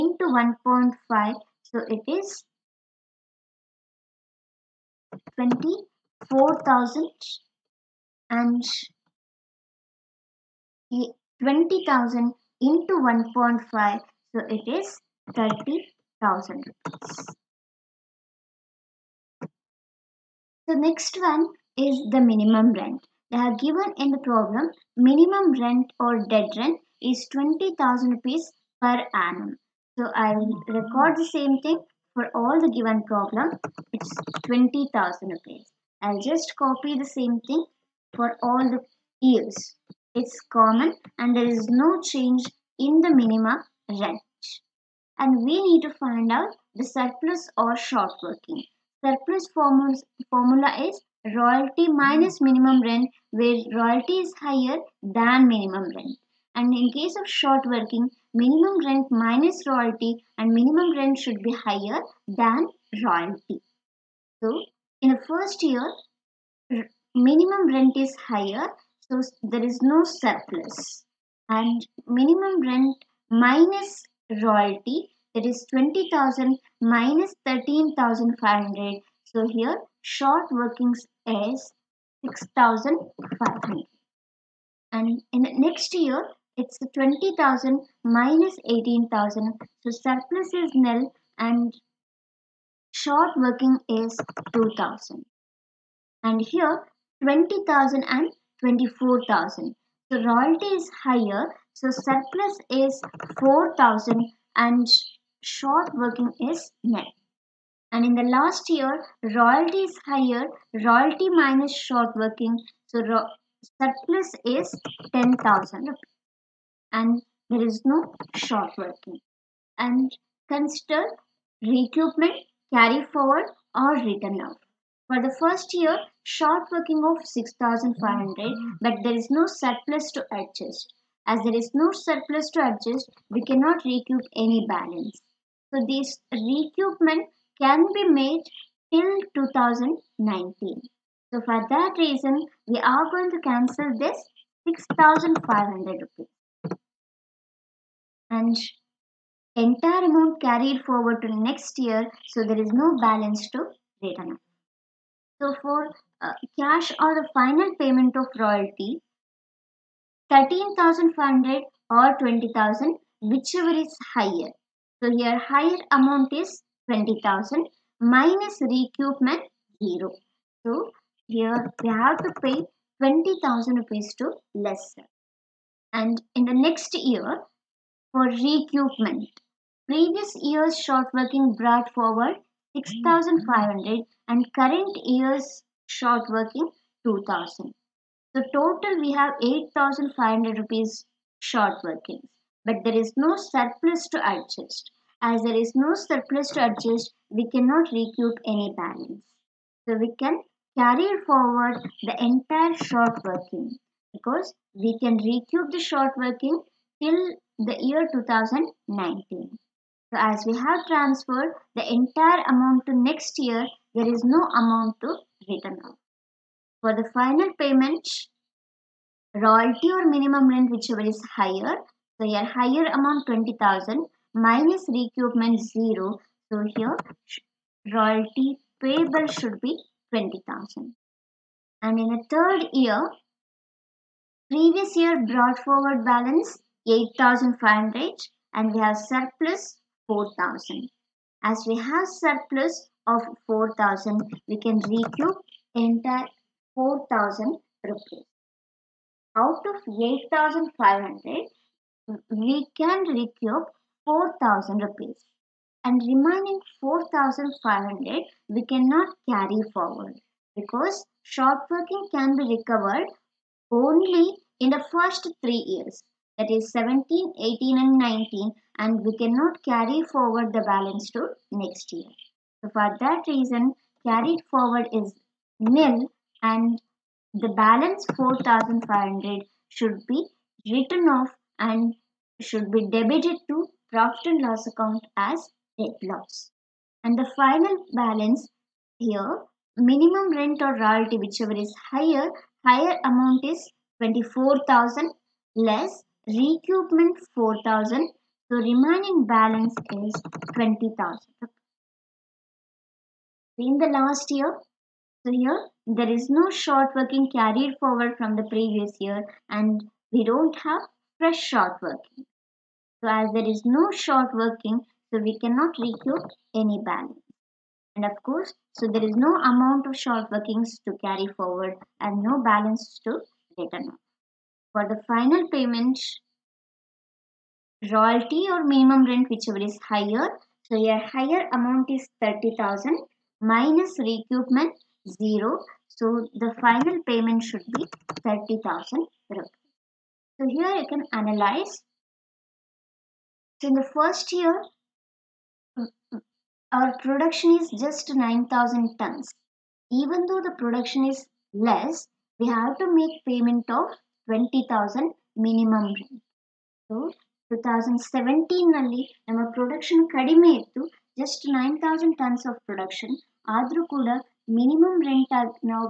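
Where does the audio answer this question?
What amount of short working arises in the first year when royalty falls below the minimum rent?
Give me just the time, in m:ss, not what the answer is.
1:20.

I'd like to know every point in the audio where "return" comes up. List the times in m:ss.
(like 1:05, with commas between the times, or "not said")
2:34, 3:35, 5:23.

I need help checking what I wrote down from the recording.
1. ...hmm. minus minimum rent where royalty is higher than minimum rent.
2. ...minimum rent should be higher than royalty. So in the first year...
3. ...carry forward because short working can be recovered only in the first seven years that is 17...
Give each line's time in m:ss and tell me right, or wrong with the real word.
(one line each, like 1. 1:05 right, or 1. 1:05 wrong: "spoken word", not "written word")
1. 0:51 right
2. 1:00 right
3. 4:19 wrong: "three", not "seven".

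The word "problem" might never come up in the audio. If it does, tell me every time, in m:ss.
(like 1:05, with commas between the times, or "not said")
0:24, 0:33.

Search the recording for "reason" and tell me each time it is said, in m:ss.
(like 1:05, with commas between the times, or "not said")
2:21, 4:33.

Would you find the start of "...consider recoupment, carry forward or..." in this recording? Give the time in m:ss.
2:00.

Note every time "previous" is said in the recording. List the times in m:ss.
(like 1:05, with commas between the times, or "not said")
2:59, 3:54, 5:08.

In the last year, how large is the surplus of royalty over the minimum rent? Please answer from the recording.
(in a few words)
10,000.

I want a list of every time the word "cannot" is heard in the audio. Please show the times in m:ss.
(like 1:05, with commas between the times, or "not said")
2:13, 3:17, 4:18, 4:29, 5:15.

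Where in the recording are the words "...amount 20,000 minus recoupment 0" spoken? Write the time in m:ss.
3:42.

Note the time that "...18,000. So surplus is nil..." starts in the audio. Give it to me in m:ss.
1:28.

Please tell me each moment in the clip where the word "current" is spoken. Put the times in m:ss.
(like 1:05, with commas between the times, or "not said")
3:04.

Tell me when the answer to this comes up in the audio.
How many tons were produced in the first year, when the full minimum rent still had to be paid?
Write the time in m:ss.
5:48.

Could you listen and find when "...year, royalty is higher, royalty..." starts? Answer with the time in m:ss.
1:48.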